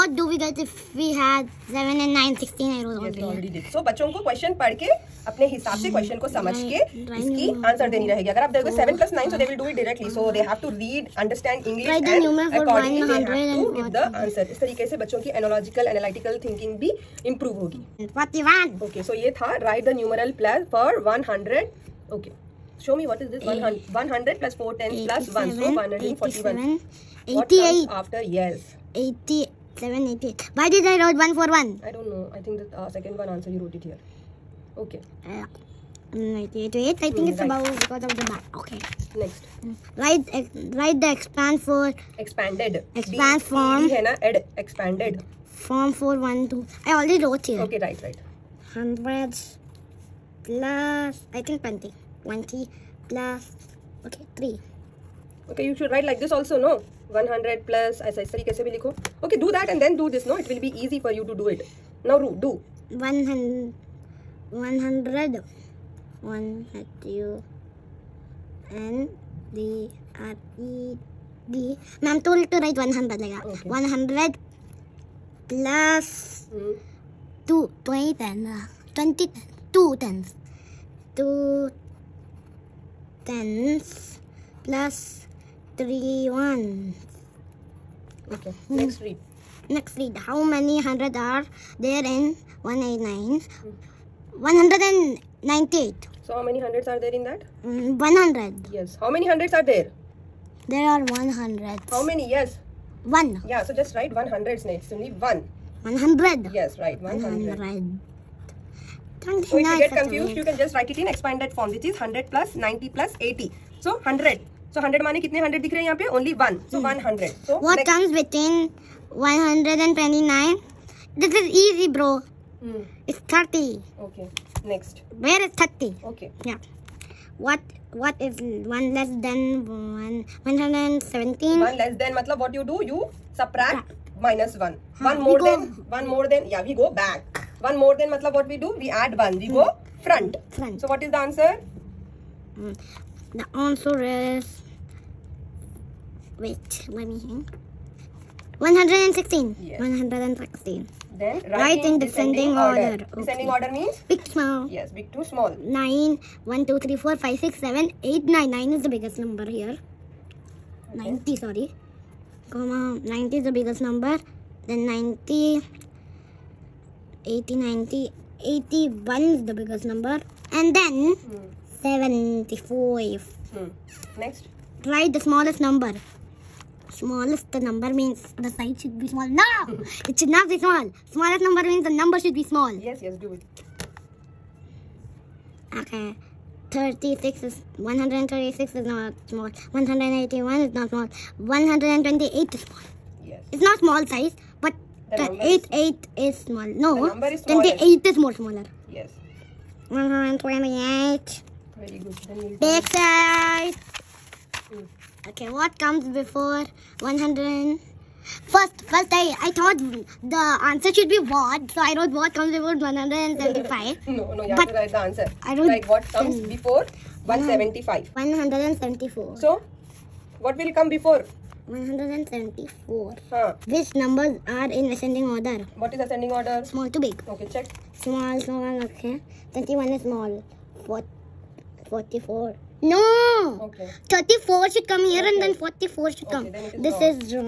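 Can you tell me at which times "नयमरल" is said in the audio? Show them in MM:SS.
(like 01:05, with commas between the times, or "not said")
00:19.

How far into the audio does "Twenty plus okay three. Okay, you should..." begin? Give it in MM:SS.
00:52.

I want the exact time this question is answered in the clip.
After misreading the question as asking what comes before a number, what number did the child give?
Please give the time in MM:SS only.
03:38.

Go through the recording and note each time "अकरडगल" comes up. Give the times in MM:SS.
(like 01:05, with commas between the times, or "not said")
00:12.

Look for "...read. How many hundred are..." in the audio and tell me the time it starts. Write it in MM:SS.
01:29.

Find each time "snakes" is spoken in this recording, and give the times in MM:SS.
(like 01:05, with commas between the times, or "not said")
01:44.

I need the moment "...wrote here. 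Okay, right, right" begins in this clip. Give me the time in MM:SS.
00:47.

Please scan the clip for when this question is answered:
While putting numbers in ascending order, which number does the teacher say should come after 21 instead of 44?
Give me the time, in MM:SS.
03:54.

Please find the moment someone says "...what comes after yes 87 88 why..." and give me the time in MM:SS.
00:27.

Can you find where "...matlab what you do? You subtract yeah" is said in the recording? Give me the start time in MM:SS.
02:12.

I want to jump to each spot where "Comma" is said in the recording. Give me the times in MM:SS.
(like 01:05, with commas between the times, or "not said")
02:42.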